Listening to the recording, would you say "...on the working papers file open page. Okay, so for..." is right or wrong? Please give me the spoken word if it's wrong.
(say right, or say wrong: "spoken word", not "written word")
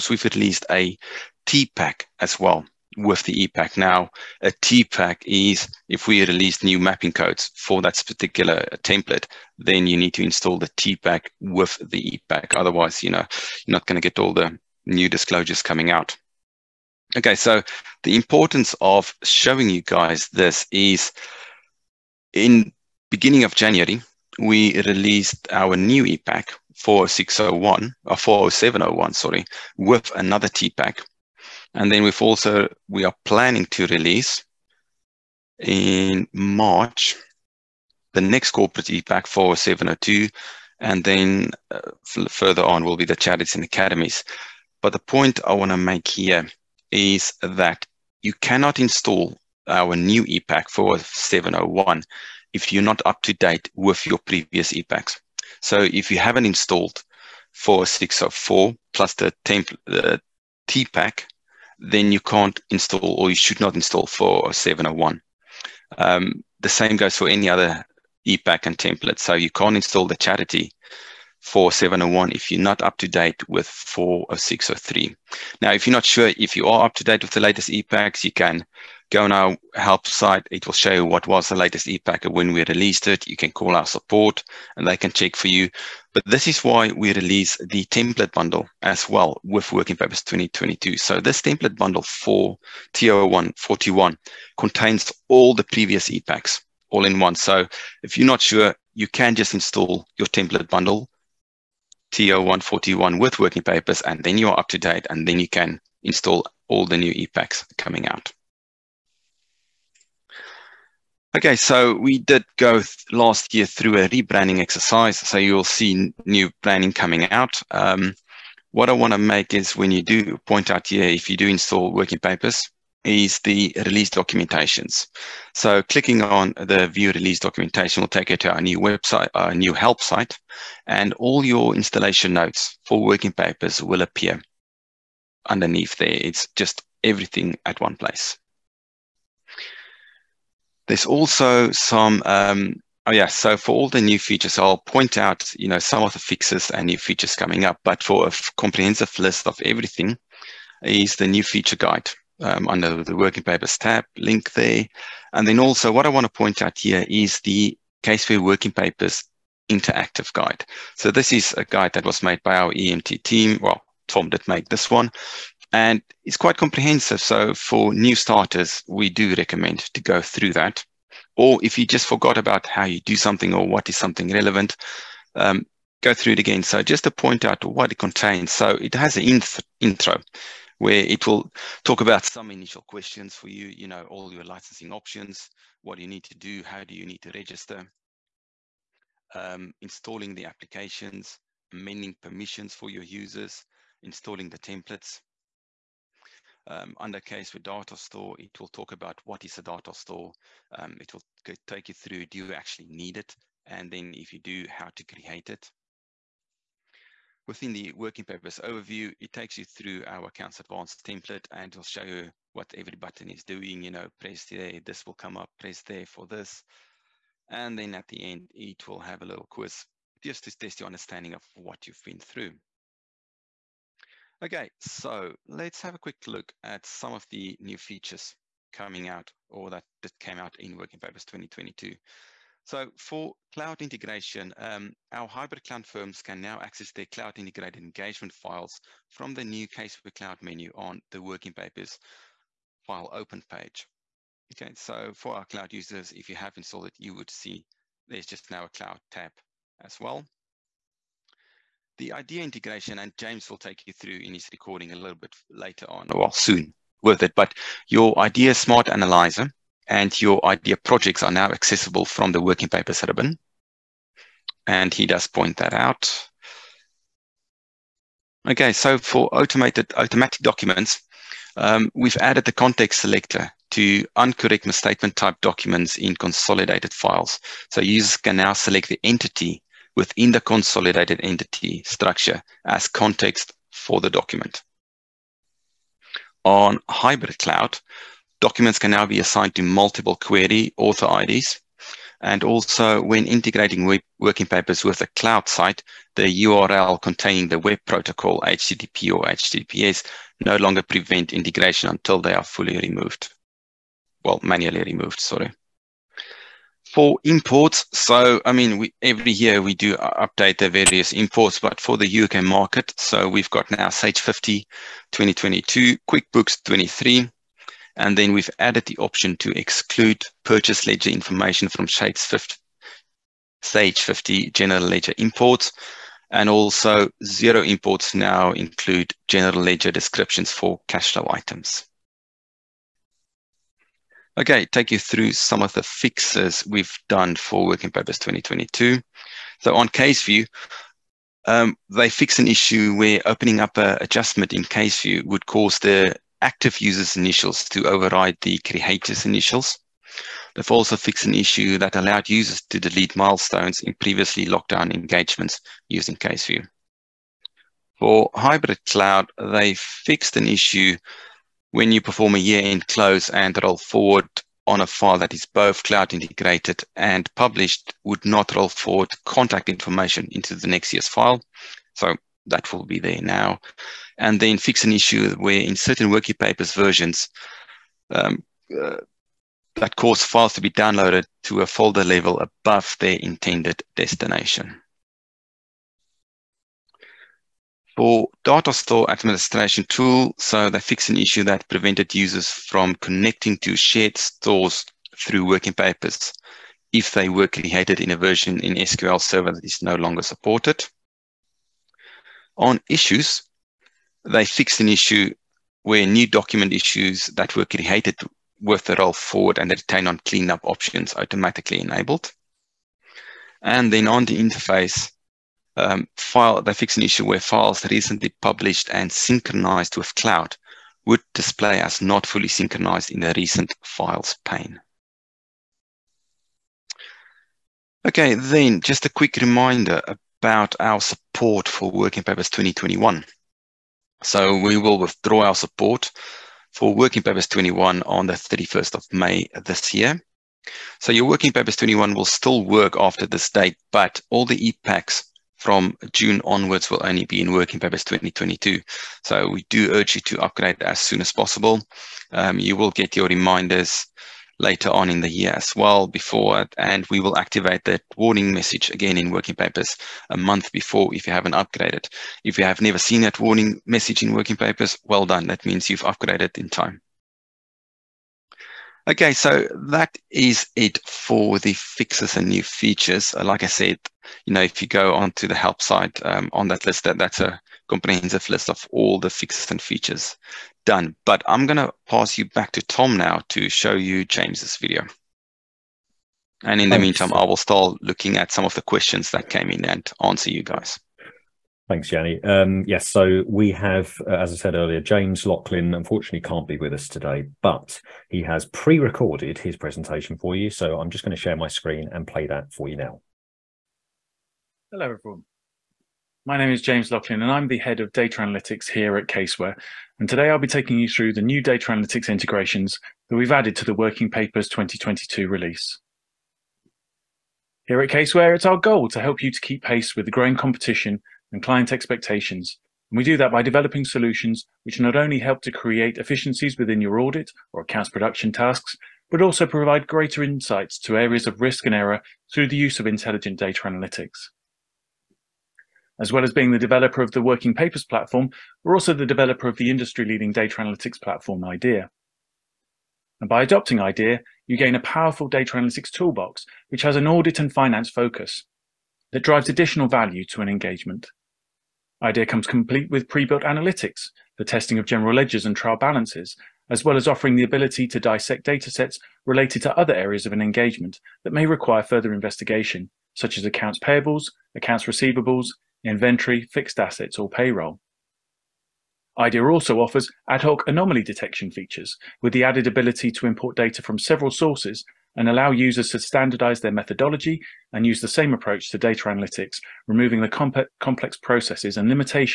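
right.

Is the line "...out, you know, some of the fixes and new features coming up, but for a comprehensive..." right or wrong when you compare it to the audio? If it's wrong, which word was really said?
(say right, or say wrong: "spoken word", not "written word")
right.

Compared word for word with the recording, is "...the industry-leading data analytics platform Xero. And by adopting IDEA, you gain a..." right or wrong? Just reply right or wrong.
wrong.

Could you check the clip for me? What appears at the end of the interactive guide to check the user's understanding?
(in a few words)
a little quiz.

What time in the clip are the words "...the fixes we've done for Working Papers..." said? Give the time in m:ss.
5:35.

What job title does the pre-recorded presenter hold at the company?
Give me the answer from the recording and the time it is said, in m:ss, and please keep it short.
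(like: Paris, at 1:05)
head of data analytics, at 8:27.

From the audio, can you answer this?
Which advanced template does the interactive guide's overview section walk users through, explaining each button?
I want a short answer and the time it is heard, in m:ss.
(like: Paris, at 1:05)
accounts advanced, at 3:30.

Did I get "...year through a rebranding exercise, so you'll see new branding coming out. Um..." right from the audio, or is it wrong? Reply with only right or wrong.
right.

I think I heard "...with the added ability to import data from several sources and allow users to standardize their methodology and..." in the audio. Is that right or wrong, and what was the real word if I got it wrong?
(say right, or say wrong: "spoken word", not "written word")
right.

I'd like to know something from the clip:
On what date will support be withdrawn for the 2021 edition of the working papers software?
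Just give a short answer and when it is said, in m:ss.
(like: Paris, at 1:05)
31 May, at 7:18.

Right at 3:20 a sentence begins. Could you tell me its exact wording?
Um, it will take you through, do you actually need it?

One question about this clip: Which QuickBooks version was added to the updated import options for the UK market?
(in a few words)
QuickBooks 23.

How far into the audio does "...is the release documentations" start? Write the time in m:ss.
2:03.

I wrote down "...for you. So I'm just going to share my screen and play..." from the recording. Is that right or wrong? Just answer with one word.
right.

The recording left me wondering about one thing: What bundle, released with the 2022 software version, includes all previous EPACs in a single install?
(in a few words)
template bundle TO 141.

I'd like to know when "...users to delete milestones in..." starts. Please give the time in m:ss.
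5:52.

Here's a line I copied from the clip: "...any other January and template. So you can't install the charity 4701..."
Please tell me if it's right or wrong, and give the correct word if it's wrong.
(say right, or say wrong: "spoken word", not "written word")
wrong: "EPAC", not "January".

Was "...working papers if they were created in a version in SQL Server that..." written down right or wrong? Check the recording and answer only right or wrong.
right.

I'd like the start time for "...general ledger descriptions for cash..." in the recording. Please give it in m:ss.
5:29.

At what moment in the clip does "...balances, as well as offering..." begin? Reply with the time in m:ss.
9:15.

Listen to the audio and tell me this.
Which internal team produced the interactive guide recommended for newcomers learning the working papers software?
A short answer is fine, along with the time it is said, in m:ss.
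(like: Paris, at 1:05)
EMT team, at 2:42.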